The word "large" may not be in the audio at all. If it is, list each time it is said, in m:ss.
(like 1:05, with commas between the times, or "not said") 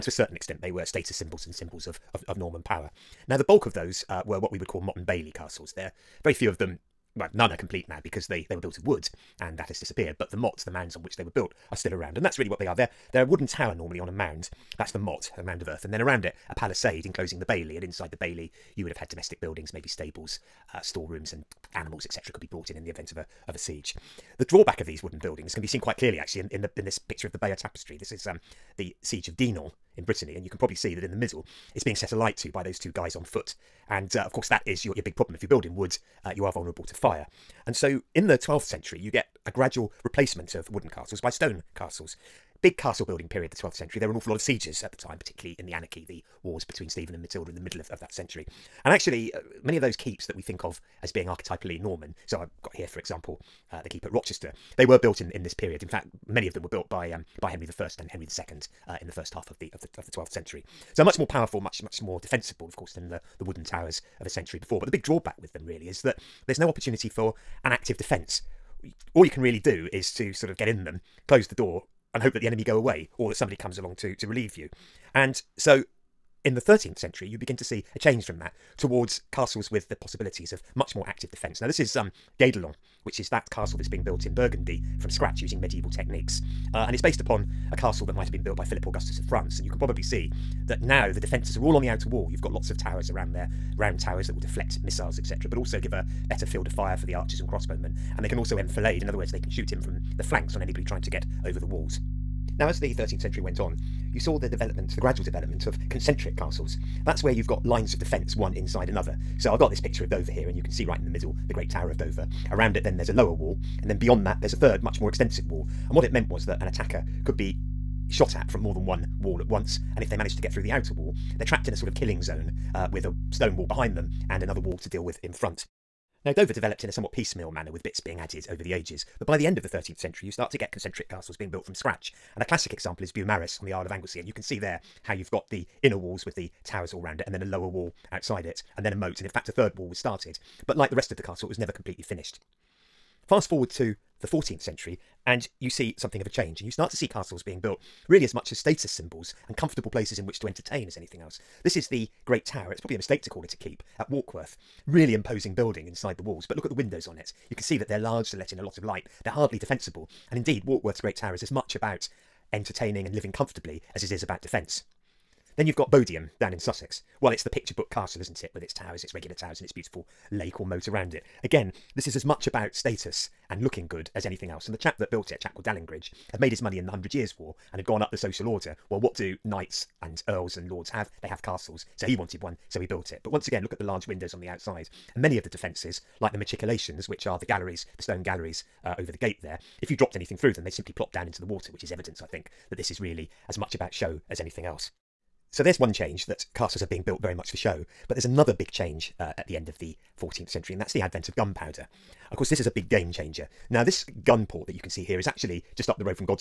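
2:37, 3:03.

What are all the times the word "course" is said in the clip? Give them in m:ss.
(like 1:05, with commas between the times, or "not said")
0:34, 1:02, 3:22.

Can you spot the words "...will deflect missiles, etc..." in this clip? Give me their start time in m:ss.
1:34.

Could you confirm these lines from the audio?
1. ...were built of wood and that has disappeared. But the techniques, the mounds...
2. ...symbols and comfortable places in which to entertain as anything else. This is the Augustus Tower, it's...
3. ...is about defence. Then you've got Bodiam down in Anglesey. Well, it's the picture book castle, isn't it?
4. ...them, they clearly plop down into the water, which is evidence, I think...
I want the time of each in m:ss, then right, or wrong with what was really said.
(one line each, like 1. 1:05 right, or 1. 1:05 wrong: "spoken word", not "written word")
1. 0:08 wrong: "mottes", not "techniques"
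2. 2:28 wrong: "Great", not "Augustus"
3. 2:44 wrong: "Sussex", not "Anglesey"
4. 3:10 wrong: "simply", not "clearly".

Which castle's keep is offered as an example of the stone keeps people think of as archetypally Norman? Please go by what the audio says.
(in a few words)
Rochester.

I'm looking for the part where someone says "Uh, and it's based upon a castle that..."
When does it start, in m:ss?
1:26.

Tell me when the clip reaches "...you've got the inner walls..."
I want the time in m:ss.
2:15.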